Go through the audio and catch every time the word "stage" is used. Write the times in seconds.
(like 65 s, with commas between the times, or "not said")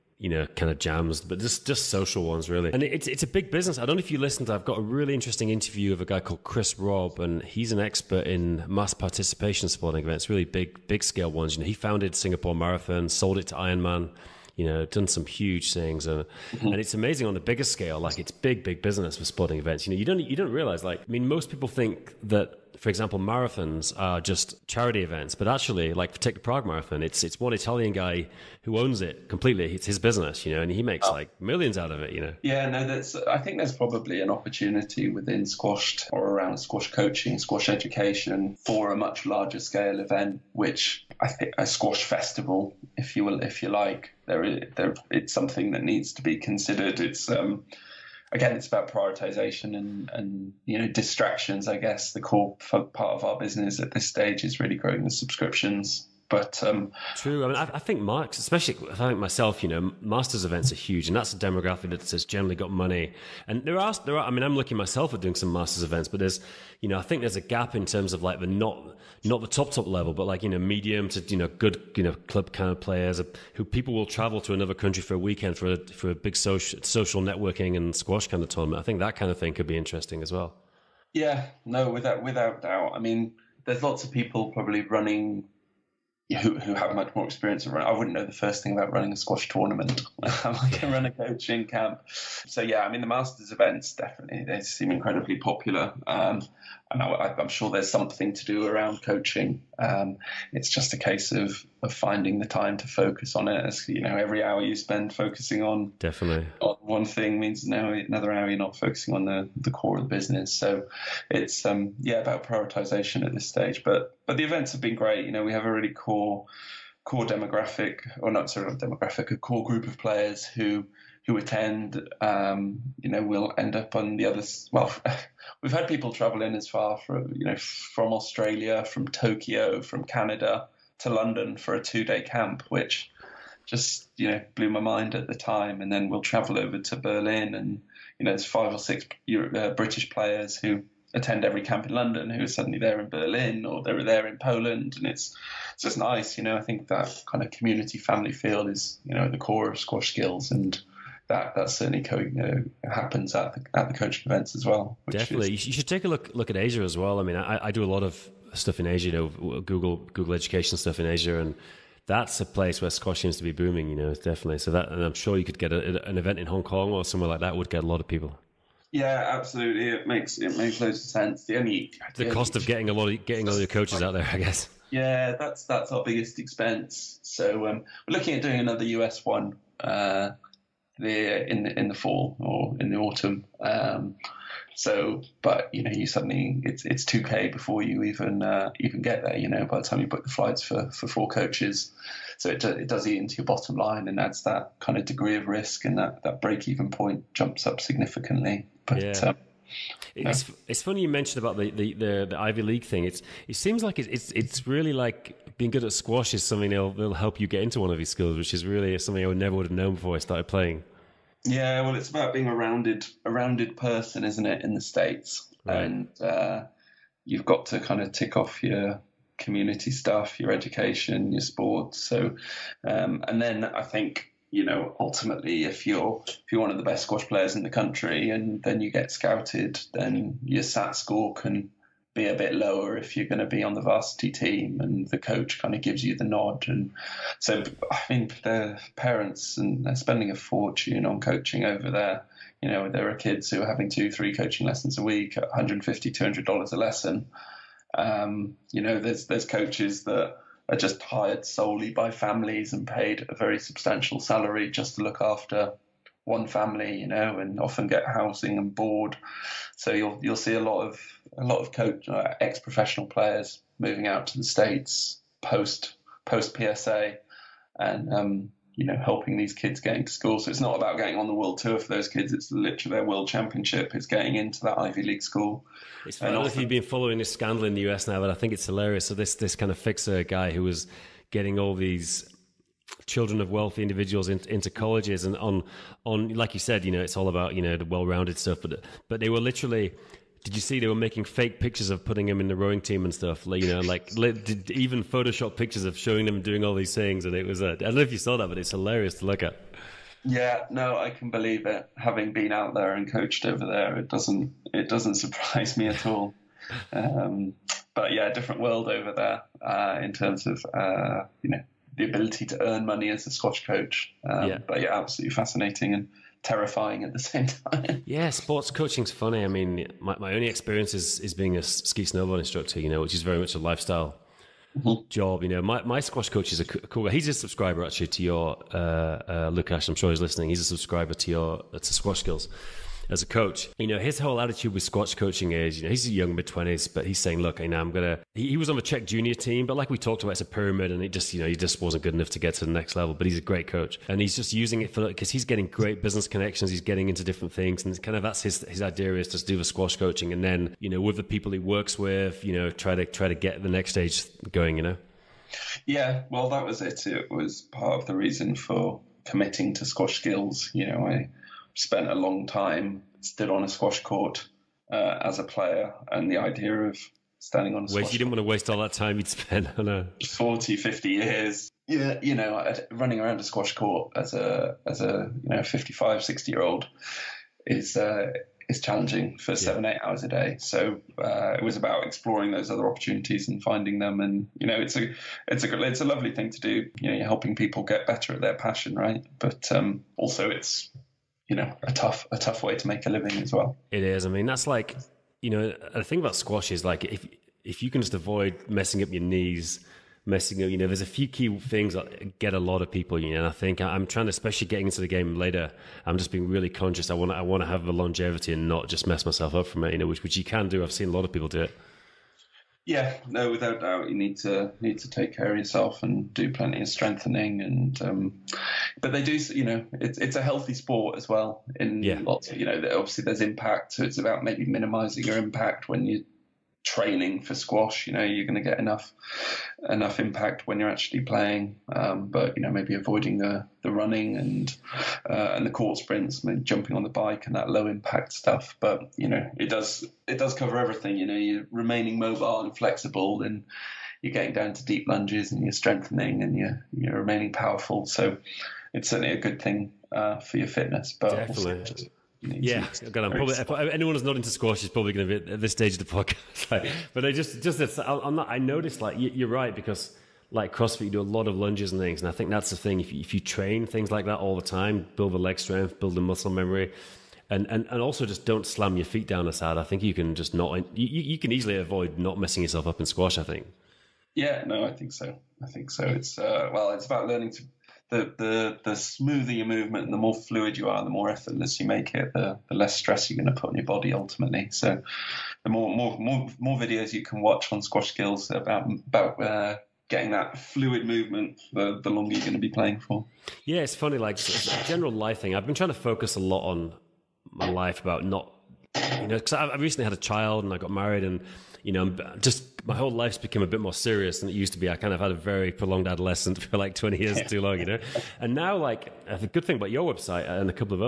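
54 s, 113 s, 353 s, 455 s.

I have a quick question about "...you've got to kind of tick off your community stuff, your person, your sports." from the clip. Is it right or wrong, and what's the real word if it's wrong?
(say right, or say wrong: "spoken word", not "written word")
wrong: "education", not "person".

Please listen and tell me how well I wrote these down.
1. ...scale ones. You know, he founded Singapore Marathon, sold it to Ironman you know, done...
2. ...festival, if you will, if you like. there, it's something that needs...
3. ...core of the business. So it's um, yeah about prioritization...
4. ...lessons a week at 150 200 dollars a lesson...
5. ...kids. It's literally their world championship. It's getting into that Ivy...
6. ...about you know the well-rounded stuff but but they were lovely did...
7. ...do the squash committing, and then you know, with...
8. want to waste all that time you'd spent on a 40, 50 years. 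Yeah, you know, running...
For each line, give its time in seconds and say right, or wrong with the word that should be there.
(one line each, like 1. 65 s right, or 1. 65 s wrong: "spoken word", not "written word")
1. 11 s right
2. 42 s right
3. 109 s right
4. 244 s right
5. 272 s right
6. 287 s wrong: "literally", not "lovely"
7. 349 s wrong: "coaching", not "committing"
8. 368 s right.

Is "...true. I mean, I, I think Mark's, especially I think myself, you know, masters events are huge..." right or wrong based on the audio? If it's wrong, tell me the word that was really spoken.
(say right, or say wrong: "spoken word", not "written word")
right.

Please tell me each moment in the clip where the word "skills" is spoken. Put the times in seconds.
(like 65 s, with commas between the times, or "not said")
150 s, 332 s, 360 s, 488 s.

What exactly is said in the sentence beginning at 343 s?
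But he's a great coach, and he's just using it for because he's getting great business connections.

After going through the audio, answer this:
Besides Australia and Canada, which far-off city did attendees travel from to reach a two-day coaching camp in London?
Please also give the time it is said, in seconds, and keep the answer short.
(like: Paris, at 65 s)
Tokyo, at 129 s.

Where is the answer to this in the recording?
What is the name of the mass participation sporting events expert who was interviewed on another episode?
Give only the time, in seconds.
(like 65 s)
6 s.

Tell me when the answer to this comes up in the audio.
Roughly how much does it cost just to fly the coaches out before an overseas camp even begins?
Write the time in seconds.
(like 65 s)
187 s.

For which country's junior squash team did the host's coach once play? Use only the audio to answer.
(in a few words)
Czech.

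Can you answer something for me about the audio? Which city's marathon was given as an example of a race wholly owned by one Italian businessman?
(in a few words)
Prague.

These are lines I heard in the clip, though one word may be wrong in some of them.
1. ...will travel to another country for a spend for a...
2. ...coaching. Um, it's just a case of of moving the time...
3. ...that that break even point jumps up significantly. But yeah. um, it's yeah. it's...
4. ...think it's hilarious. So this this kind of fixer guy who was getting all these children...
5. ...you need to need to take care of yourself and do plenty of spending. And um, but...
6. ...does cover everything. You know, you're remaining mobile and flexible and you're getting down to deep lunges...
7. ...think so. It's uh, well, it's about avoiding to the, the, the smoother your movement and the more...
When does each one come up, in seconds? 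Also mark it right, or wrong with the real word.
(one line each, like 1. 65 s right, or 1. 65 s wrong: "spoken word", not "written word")
1. 73 s wrong: "weekend", not "spend"
2. 99 s wrong: "finding", not "moving"
3. 195 s right
4. 278 s right
5. 414 s wrong: "strengthening", not "spending"
6. 440 s right
7. 475 s wrong: "learning", not "avoiding".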